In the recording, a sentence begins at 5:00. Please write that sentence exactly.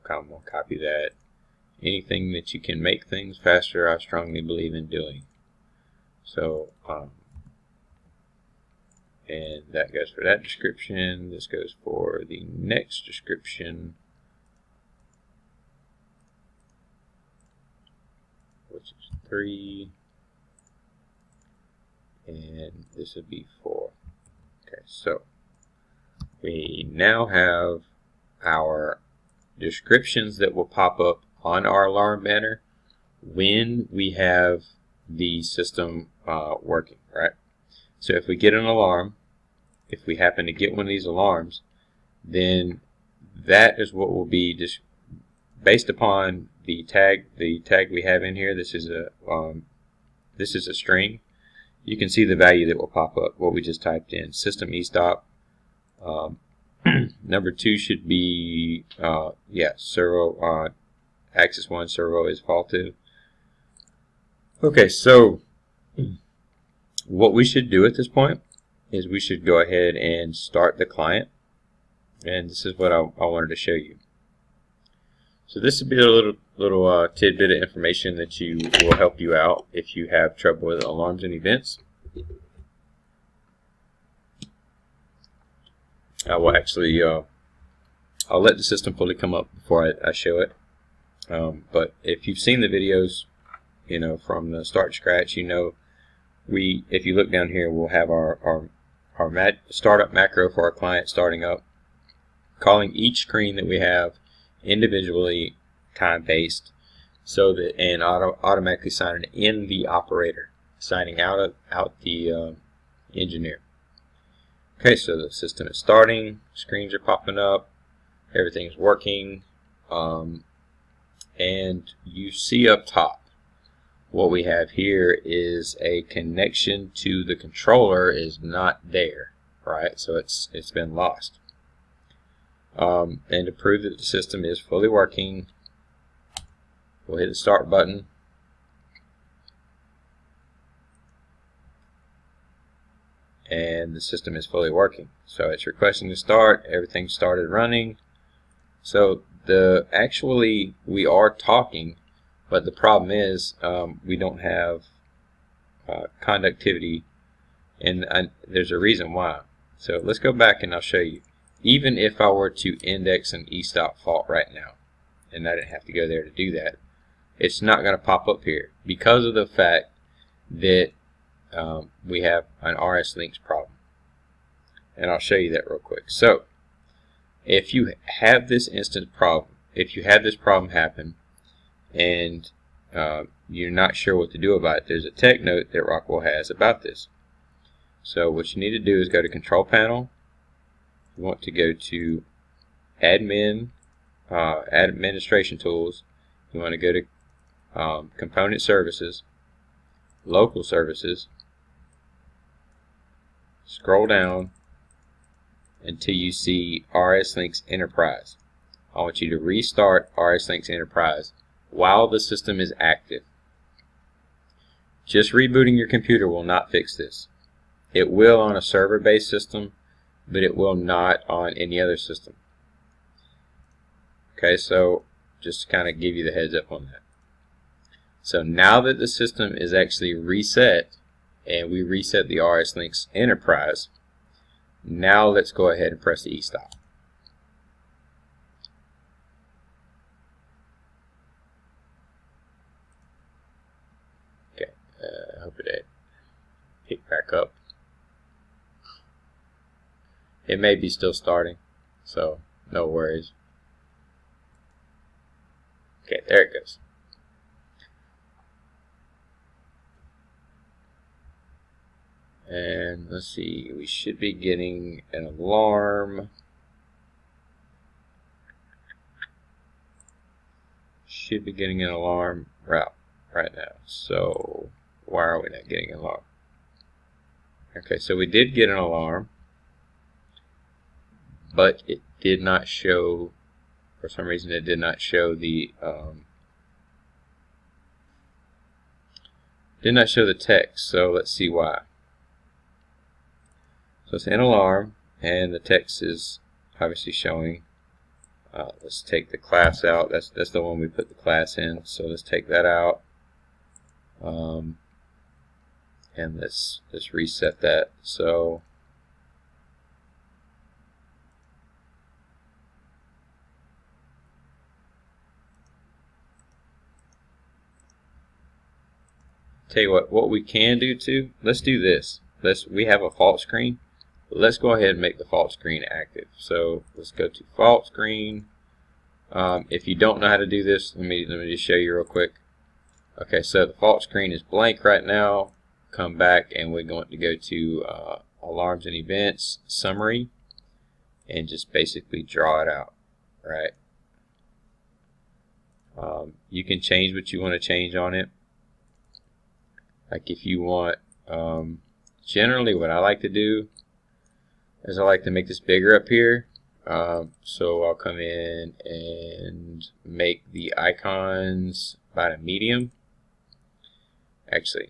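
That's that's the one we put the class in.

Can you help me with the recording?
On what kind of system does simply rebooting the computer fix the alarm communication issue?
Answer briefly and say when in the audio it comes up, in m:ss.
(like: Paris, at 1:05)
Server-based system, at 3:38.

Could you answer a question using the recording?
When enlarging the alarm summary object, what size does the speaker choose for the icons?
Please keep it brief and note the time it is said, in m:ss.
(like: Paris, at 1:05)
Medium, at 6:02.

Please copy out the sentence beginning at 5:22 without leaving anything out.
Let's we have a fault screen let's go ahead and make the fault screen active.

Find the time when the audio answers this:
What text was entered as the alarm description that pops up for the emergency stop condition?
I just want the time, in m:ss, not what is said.
0:54.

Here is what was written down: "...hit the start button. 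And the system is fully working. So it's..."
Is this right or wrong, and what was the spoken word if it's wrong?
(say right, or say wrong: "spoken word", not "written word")
right.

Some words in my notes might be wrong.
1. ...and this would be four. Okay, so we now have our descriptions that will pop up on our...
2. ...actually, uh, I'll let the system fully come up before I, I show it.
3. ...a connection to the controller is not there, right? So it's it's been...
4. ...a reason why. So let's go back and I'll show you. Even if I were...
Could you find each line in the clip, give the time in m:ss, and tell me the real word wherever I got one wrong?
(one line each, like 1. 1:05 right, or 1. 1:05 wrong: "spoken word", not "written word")
1. 0:22 right
2. 1:26 right
3. 2:05 right
4. 2:38 right.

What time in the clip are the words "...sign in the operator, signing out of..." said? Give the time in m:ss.
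1:48.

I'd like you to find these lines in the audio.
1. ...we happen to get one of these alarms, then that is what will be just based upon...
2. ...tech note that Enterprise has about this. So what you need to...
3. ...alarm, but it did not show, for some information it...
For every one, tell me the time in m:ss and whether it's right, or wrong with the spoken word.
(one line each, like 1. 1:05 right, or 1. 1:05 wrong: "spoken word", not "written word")
1. 0:40 right
2. 3:05 wrong: "Rockwell", not "Enterprise"
3. 4:38 wrong: "reason", not "information".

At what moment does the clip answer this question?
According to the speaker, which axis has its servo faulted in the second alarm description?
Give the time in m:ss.
1:01.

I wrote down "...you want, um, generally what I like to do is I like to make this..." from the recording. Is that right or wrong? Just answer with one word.
right.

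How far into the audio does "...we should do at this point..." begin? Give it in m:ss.
1:07.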